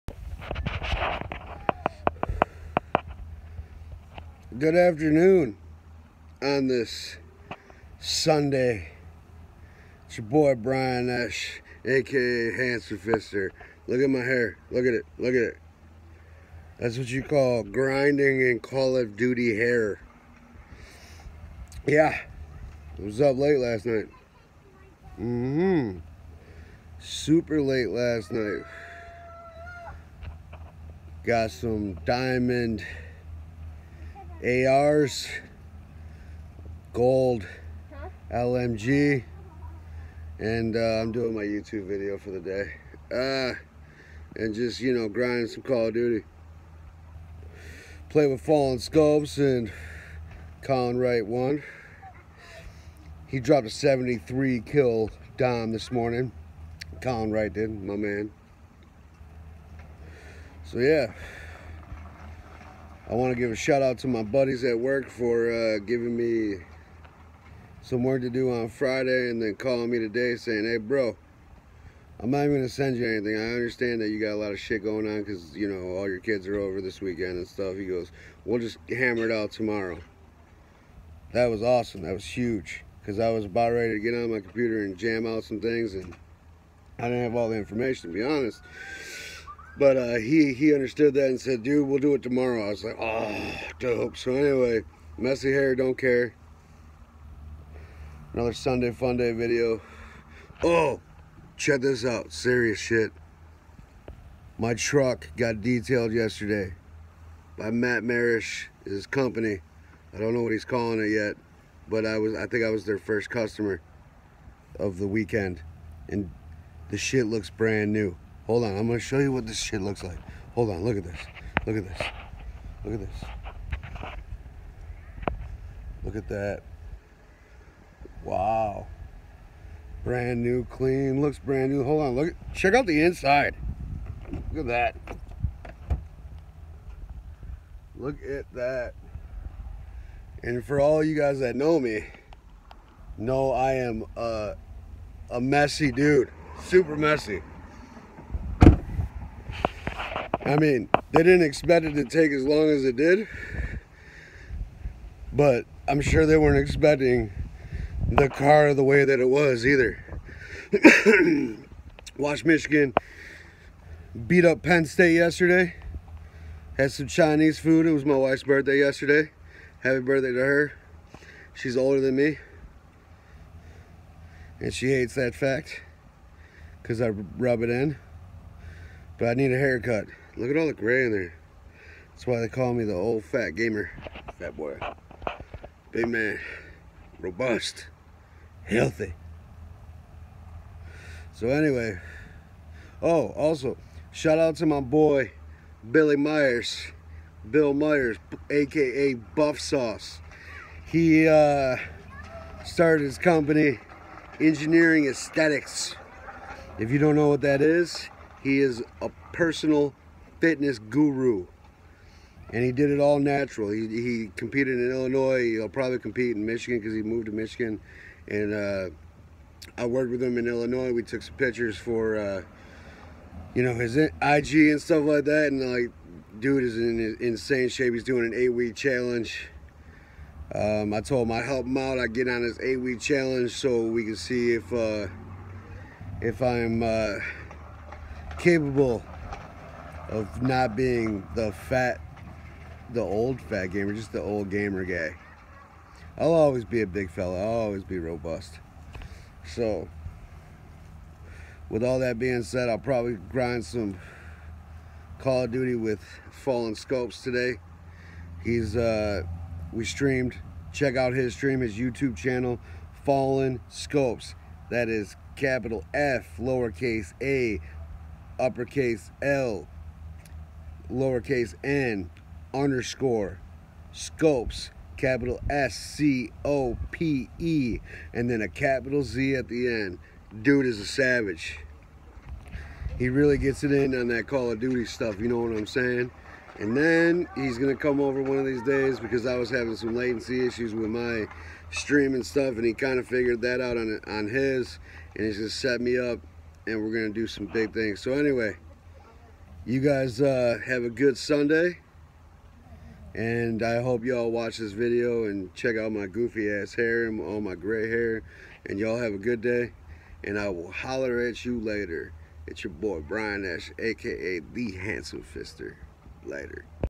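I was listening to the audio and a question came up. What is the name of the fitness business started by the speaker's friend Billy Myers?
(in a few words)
Engineering Aesthetics.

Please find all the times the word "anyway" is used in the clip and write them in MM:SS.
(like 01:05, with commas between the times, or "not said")
01:34, 03:11, 04:58.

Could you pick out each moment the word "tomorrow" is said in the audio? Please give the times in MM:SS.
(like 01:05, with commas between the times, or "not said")
01:19, 01:32.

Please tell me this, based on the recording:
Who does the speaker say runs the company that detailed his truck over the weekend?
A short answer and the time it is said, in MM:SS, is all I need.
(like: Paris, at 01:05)
Matt Marish, at 01:47.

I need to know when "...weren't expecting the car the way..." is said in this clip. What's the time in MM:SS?
02:36.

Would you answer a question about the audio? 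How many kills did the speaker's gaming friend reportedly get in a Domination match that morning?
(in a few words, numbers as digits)
73.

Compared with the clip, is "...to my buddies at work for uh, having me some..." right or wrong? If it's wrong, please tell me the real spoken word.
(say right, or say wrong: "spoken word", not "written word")
wrong: "giving", not "having".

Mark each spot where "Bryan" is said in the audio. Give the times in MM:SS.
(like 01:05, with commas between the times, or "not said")
00:10, 05:13.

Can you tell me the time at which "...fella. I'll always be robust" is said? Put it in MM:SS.
04:07.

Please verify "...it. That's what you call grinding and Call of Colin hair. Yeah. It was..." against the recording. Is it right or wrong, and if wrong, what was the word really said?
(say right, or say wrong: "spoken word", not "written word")
wrong: "Duty", not "Colin".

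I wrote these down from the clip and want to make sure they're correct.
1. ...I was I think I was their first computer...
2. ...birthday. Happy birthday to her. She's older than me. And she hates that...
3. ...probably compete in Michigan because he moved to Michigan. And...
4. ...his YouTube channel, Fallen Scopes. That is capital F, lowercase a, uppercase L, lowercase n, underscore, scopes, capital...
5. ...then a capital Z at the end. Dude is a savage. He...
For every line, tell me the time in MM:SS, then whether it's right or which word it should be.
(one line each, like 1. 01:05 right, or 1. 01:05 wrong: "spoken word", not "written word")
1. 01:52 wrong: "customer", not "computer"
2. 02:48 wrong: "yesterday", not "birthday"
3. 03:35 right
4. 04:21 right
5. 04:38 right.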